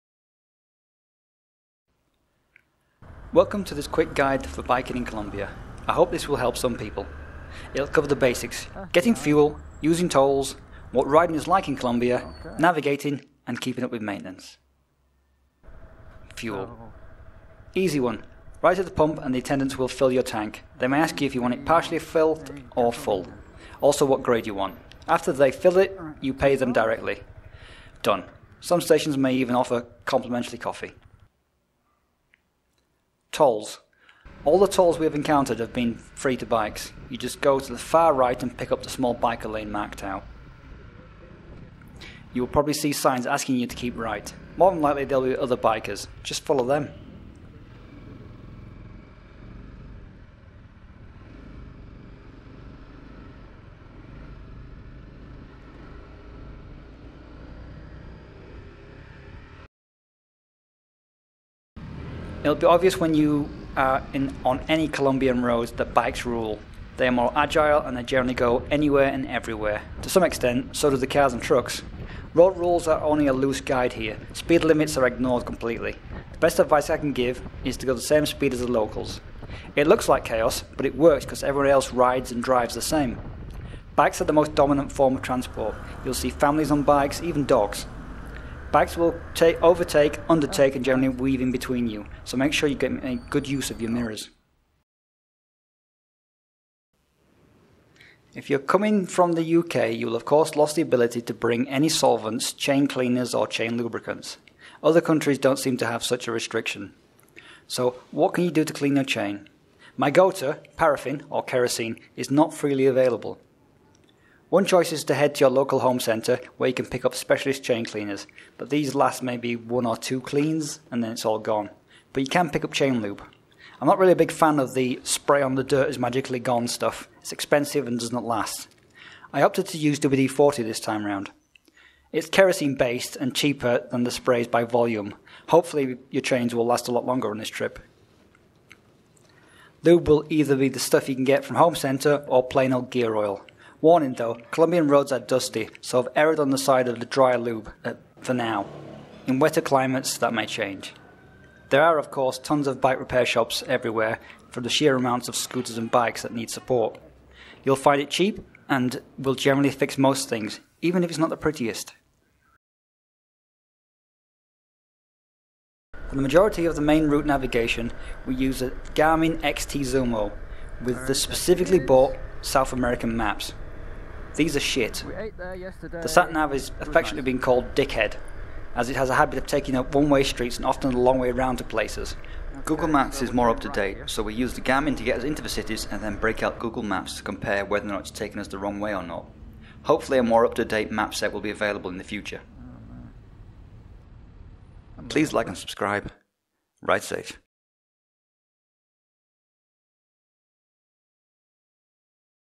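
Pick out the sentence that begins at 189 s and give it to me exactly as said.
Hopefully, a more up to date map set will be available in the future.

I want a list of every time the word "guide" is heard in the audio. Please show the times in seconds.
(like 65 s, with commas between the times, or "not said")
4 s, 73 s.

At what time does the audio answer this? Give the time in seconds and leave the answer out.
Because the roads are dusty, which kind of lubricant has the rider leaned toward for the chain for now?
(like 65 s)
147 s.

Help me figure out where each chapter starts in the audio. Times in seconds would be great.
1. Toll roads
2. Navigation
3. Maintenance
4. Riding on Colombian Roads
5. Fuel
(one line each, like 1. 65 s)
1. 31 s
2. 163 s
3. 95 s
4. 60 s
5. 12 s.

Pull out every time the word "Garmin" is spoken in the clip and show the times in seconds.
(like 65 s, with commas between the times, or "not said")
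168 s, 184 s.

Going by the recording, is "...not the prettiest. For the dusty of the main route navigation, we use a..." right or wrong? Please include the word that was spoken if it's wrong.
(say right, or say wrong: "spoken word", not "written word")
wrong: "majority", not "dusty".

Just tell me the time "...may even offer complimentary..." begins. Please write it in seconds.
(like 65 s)
29 s.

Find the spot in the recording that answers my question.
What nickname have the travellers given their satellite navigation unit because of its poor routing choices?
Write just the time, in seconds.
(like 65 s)
177 s.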